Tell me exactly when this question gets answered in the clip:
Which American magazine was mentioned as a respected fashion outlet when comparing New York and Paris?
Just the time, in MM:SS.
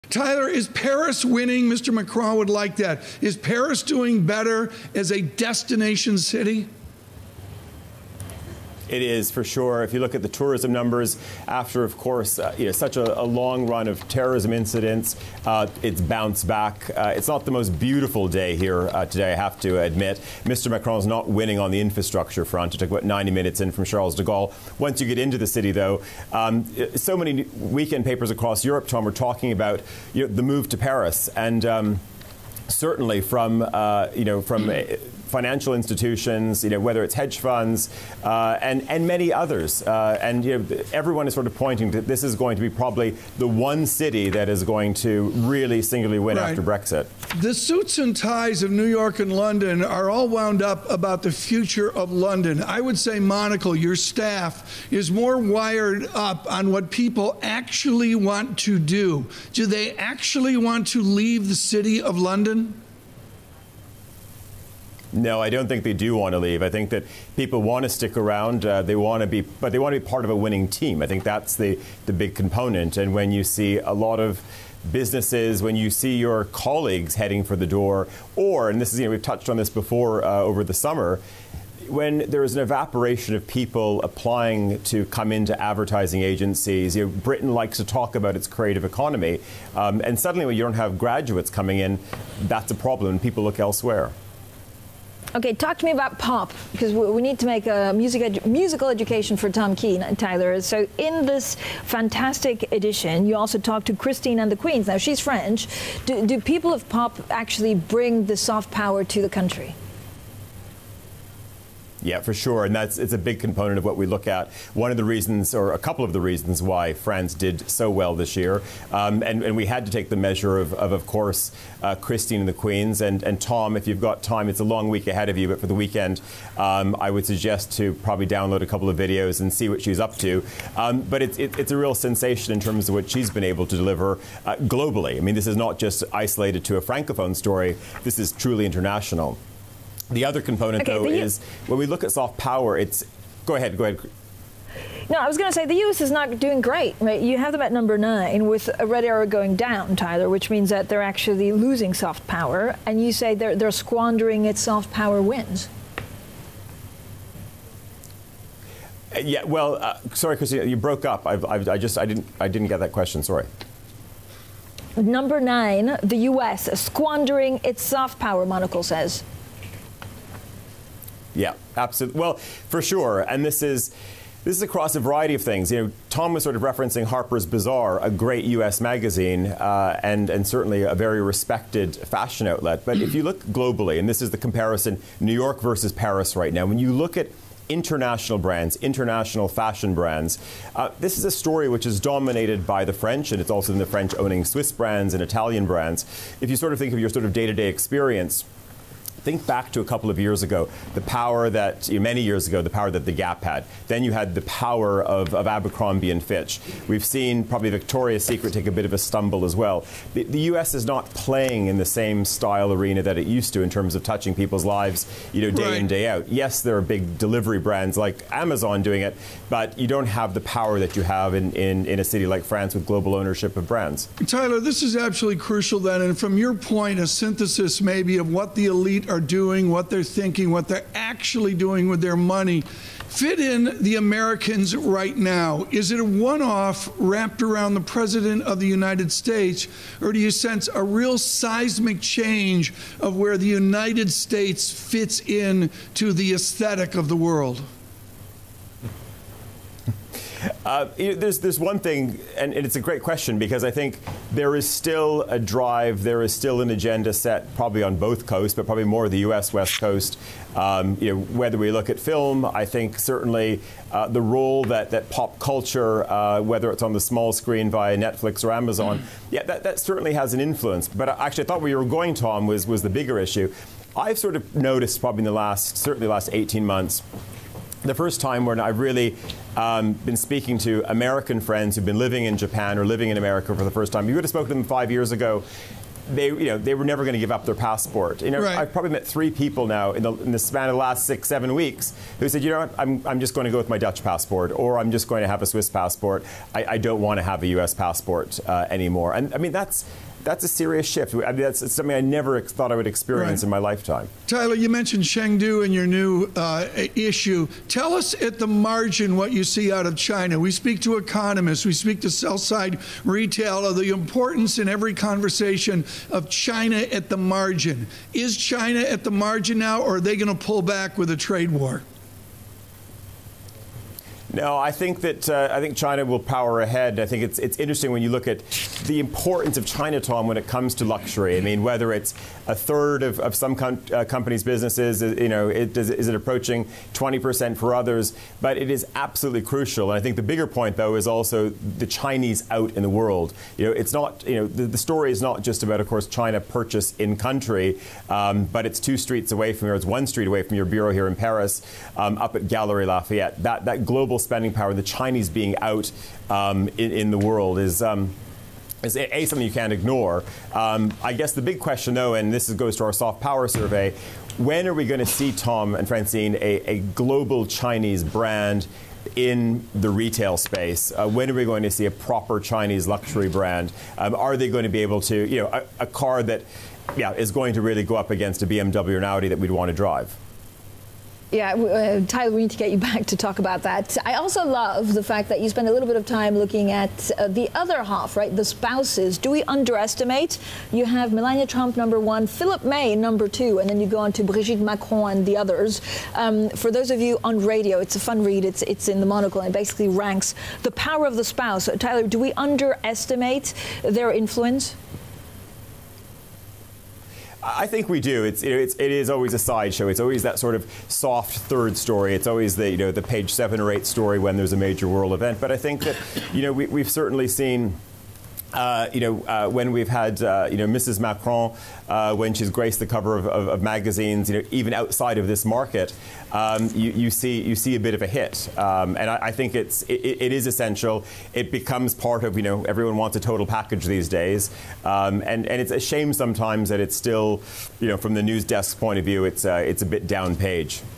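02:57.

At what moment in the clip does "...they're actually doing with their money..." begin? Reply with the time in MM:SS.
03:50.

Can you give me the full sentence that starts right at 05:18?
Is China at the margin now, or are they going to pull back with a trade war?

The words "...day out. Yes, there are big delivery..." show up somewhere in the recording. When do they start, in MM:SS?
03:35.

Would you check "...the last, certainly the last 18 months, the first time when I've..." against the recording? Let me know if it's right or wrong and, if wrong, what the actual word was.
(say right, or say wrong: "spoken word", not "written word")
right.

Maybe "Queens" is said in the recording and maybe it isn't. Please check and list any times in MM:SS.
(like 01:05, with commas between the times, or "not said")
01:44, 02:02.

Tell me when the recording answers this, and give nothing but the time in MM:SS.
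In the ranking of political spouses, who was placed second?
06:32.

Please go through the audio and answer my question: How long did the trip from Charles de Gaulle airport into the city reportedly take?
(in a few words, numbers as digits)
90 minutes.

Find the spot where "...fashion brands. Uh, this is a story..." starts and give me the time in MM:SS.
03:09.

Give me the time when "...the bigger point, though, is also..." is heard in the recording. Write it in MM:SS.
05:40.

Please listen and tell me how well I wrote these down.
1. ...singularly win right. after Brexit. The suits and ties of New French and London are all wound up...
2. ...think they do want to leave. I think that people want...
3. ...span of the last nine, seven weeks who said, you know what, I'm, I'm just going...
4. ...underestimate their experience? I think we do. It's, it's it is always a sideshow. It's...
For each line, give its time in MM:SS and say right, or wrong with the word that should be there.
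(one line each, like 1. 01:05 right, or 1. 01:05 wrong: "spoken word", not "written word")
1. 00:45 wrong: "York", not "French"
2. 01:05 right
3. 04:50 wrong: "six", not "nine"
4. 06:42 wrong: "influence", not "experience".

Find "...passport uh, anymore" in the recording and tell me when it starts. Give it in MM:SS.
04:57.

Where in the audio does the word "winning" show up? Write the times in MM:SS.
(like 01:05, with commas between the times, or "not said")
00:01, 00:21, 01:10.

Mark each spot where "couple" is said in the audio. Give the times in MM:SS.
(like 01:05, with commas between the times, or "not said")
01:55, 02:08, 03:19.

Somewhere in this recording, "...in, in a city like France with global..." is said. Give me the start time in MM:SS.
03:41.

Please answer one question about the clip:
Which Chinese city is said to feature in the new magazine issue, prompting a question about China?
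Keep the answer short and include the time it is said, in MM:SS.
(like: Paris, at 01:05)
Chengdu, at 05:05.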